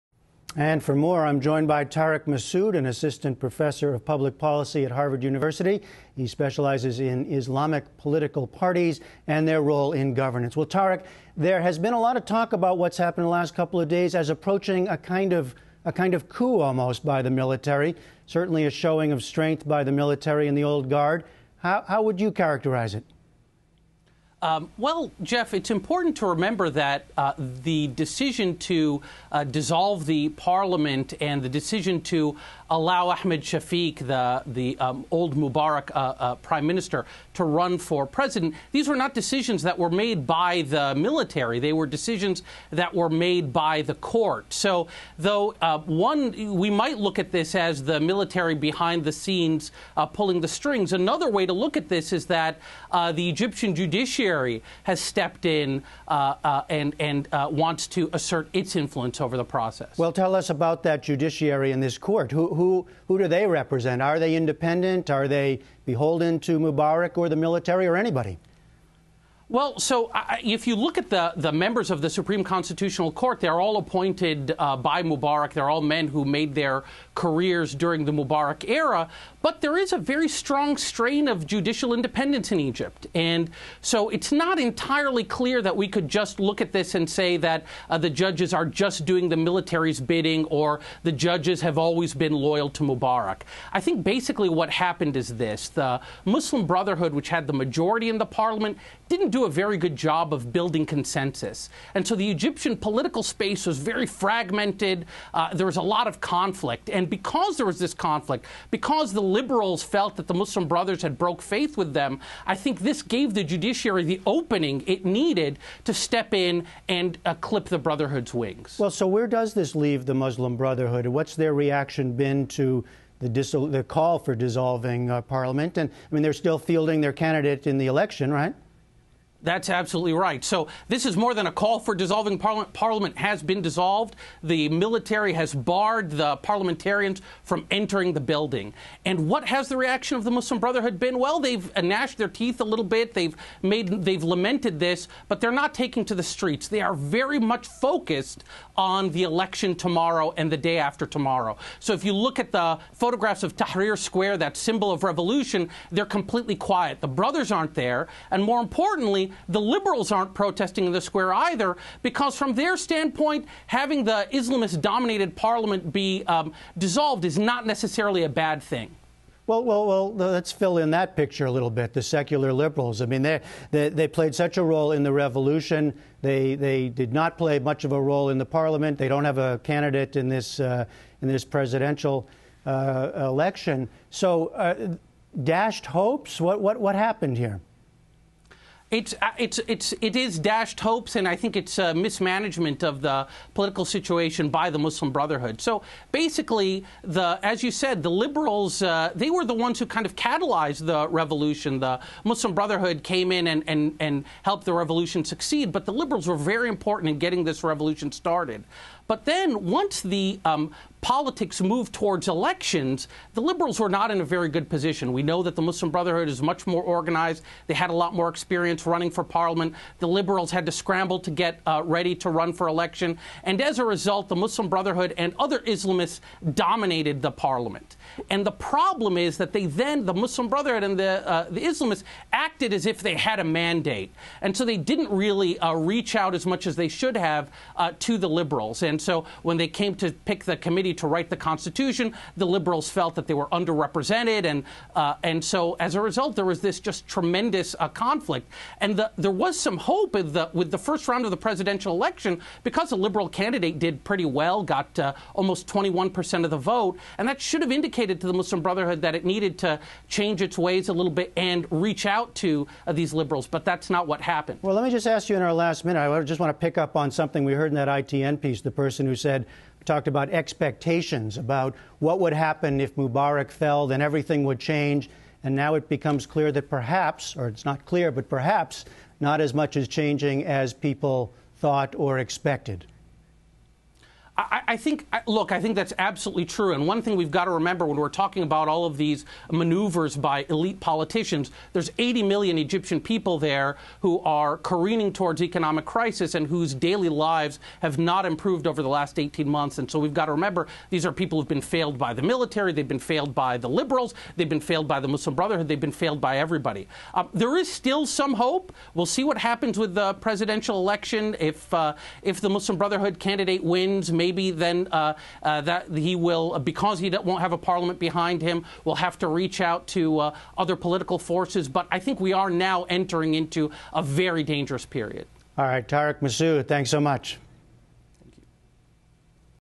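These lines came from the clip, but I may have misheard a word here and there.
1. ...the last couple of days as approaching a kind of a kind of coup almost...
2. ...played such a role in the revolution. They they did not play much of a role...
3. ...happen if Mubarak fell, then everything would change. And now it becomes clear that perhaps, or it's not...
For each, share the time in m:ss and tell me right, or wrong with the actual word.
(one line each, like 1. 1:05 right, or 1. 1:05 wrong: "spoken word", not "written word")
1. 0:13 right
2. 2:54 right
3. 4:32 right.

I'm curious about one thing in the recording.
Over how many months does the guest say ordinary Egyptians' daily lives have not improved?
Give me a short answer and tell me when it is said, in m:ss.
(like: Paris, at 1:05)
18 months, at 4:59.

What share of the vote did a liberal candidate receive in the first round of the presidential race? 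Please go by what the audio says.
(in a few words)
almost 21 percent.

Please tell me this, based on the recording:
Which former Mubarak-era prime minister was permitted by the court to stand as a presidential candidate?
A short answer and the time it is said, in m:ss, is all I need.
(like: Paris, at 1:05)
Ahmed Shafiq, at 0:33.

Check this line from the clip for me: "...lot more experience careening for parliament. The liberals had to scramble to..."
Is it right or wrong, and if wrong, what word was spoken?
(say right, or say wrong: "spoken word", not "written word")
wrong: "running", not "careening".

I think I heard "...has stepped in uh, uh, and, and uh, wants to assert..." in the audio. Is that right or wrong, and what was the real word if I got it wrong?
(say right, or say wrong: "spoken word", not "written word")
right.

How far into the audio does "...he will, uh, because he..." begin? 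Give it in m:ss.
5:15.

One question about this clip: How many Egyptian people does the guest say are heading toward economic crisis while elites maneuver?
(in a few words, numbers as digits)
80 million.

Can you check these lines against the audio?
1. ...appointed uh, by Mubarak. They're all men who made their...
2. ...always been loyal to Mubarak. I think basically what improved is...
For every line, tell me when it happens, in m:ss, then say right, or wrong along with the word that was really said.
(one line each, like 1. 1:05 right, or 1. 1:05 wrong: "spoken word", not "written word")
1. 1:13 right
2. 1:31 wrong: "happened", not "improved".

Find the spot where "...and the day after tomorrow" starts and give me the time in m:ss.
2:30.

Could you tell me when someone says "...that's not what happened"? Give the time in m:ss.
4:23.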